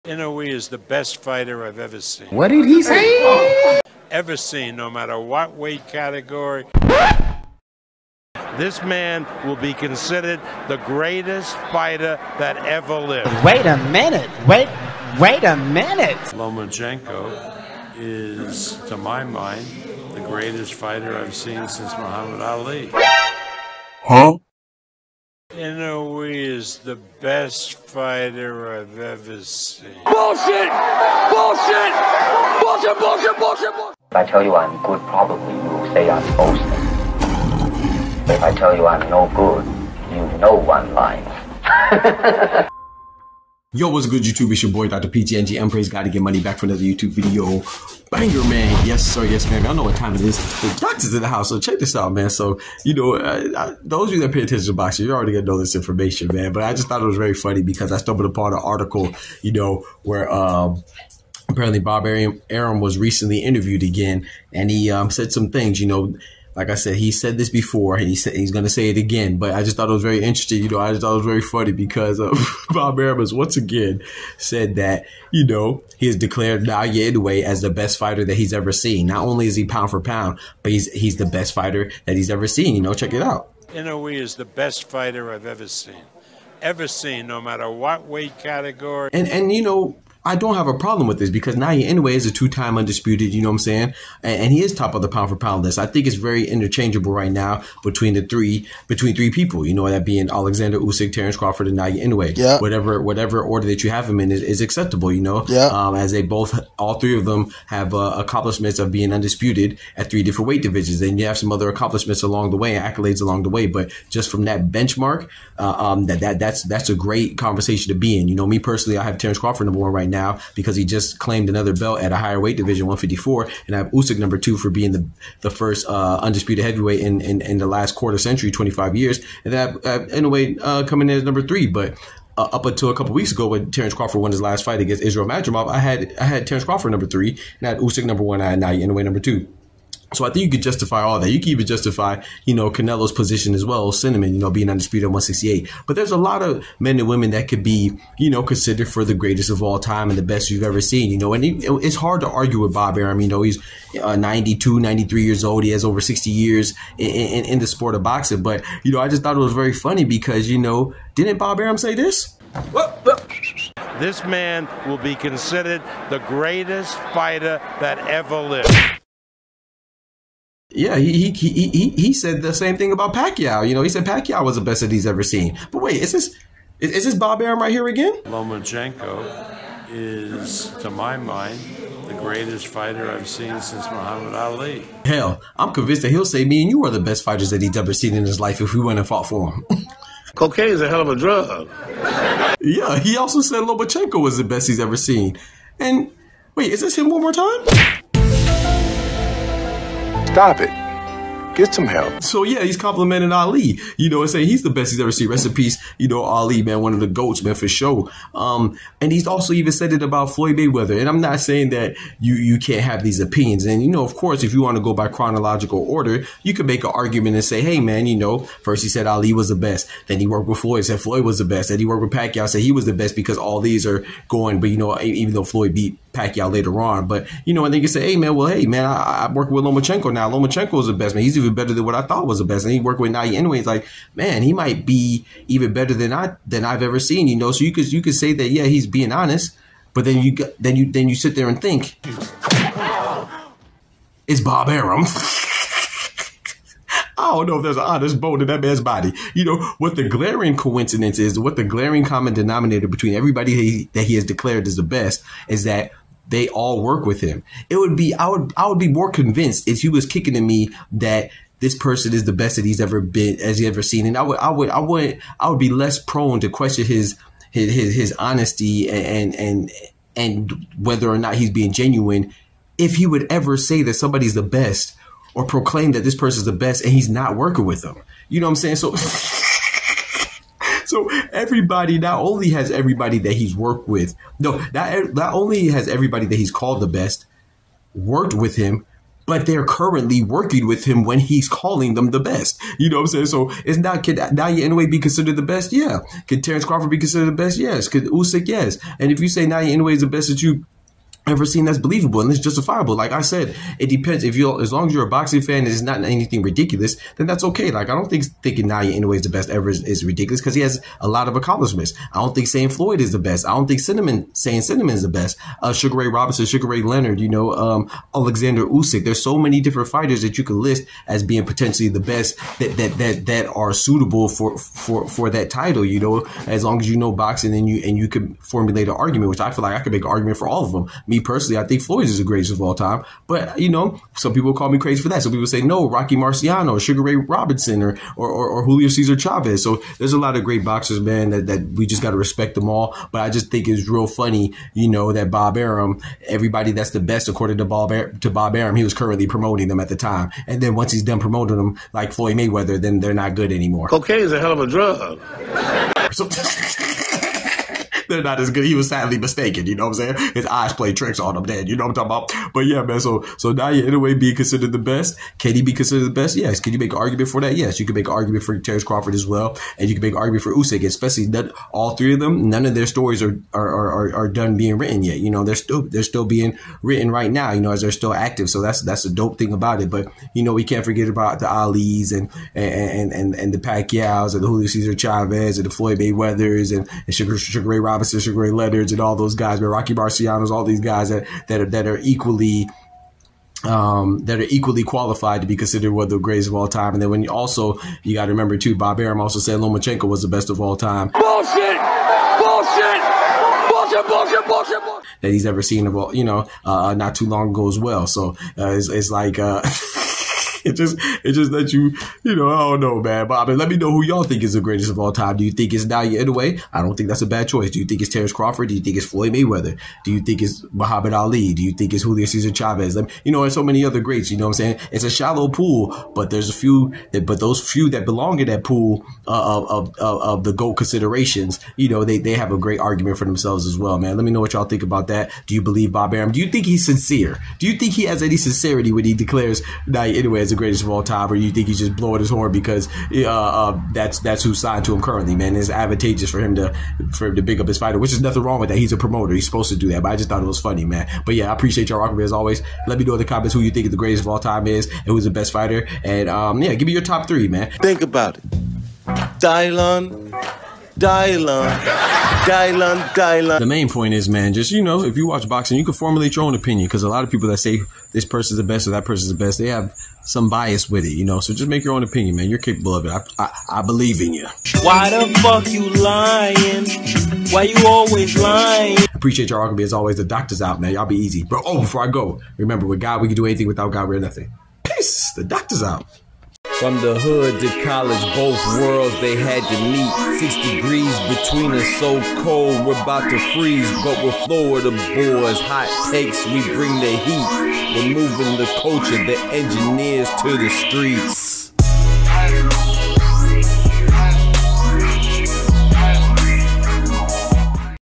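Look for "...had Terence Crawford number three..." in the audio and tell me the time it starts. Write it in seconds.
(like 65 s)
136 s.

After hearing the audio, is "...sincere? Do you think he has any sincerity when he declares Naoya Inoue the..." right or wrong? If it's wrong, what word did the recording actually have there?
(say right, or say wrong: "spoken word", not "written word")
right.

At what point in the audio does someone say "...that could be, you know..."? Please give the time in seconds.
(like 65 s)
147 s.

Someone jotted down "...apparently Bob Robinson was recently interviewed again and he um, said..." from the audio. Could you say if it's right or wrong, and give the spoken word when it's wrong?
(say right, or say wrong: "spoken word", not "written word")
wrong: "Arum", not "Robinson".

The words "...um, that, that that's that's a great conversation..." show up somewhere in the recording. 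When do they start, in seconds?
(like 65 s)
115 s.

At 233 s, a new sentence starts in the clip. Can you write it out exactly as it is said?
He's like, man, he might be even better than I than I've ever seen.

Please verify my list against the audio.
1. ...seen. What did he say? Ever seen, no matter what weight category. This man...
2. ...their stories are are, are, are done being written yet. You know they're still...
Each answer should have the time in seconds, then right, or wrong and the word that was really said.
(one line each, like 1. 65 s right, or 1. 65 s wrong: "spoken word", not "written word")
1. 2 s right
2. 372 s right.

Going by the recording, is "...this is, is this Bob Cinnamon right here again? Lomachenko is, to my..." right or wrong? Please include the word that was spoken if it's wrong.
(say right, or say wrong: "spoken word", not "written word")
wrong: "Arum", not "Cinnamon".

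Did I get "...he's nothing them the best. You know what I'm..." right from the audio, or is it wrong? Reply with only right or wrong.
wrong.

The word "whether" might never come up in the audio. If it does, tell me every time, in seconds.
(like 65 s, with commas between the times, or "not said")
270 s.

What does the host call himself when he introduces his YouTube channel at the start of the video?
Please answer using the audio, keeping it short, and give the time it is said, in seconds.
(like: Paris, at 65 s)
Dr. PGNG, at 44 s.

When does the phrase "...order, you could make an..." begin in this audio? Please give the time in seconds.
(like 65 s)
215 s.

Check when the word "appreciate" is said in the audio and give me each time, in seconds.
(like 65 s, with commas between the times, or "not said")
451 s, 479 s.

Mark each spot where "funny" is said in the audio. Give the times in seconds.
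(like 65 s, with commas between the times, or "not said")
57 s, 71 s, 159 s, 344 s, 450 s.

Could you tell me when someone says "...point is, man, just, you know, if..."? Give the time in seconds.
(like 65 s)
463 s.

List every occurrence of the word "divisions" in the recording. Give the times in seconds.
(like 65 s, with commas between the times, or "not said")
110 s, 122 s.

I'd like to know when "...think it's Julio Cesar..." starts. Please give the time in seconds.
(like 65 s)
421 s.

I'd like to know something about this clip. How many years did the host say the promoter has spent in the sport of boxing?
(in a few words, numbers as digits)
60.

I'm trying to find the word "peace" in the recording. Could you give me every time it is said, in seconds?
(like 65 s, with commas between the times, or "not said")
205 s, 484 s.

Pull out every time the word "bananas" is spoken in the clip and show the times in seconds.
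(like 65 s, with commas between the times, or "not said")
not said.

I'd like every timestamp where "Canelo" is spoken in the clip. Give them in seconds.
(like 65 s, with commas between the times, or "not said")
142 s.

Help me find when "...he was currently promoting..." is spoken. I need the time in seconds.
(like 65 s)
348 s.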